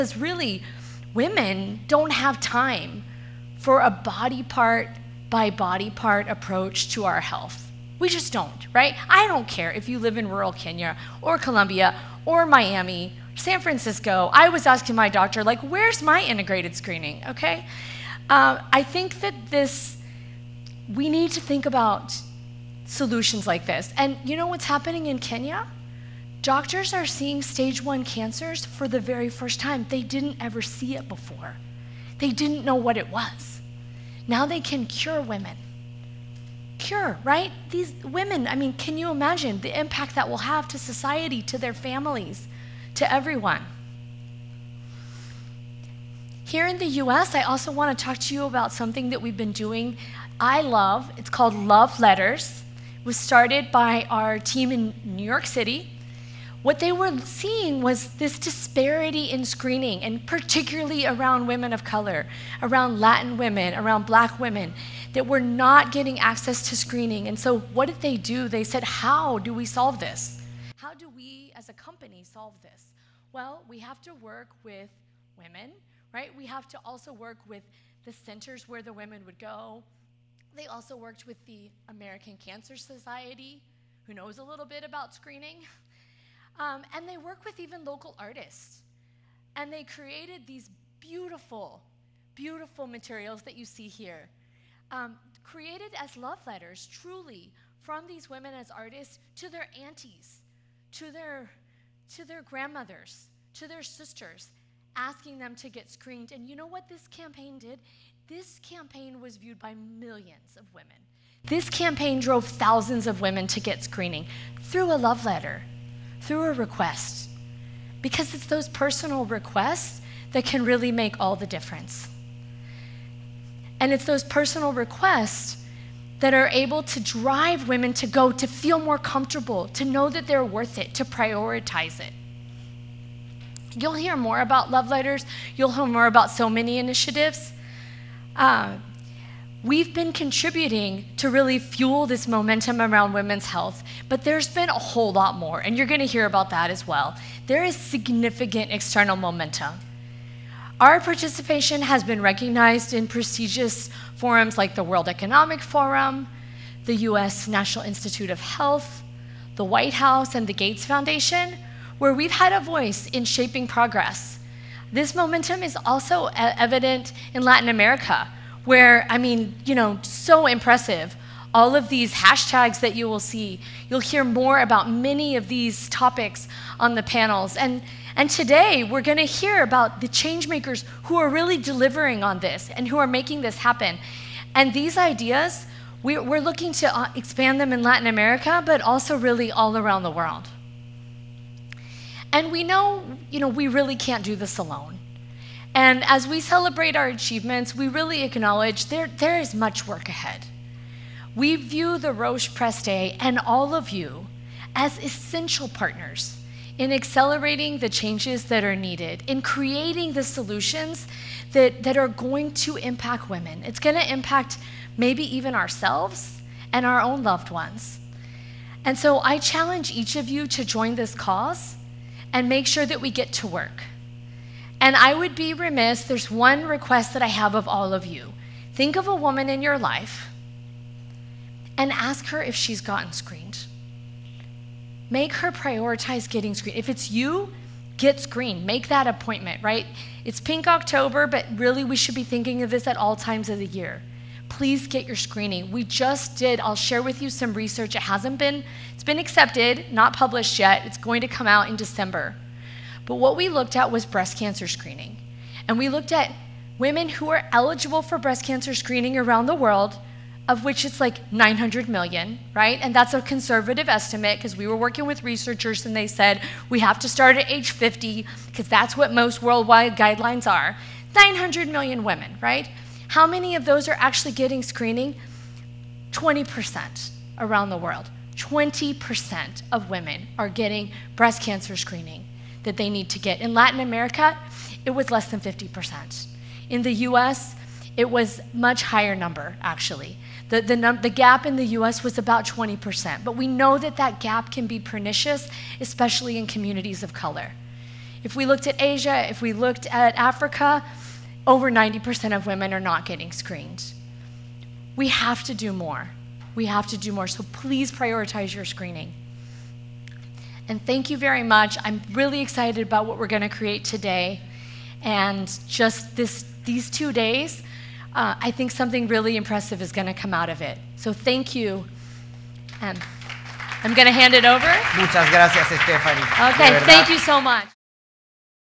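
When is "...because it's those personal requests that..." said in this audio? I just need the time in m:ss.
1:57.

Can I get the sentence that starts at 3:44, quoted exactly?
And I would be remiss, there's one request that I have of all of you.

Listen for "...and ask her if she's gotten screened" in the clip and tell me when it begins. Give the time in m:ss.
3:51.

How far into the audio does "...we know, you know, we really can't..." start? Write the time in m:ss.
3:12.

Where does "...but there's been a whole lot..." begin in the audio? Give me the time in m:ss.
2:24.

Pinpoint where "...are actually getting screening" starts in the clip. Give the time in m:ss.
4:33.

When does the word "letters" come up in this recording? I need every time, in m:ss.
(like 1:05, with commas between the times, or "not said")
0:51, 1:36, 1:55, 2:14.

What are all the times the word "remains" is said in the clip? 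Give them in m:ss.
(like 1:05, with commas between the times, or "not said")
not said.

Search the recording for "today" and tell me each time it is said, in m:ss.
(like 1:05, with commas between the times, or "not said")
2:58, 5:13.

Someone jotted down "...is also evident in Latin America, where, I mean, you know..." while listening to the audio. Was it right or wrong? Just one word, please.
right.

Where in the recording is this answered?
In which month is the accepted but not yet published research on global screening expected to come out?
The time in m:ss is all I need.
4:11.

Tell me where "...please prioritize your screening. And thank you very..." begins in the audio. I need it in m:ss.
5:07.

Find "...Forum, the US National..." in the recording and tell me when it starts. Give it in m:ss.
2:35.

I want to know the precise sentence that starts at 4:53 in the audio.
But we know that that gap can be pernicious, especially in communities of color.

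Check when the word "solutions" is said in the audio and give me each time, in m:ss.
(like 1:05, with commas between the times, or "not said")
0:22, 3:30.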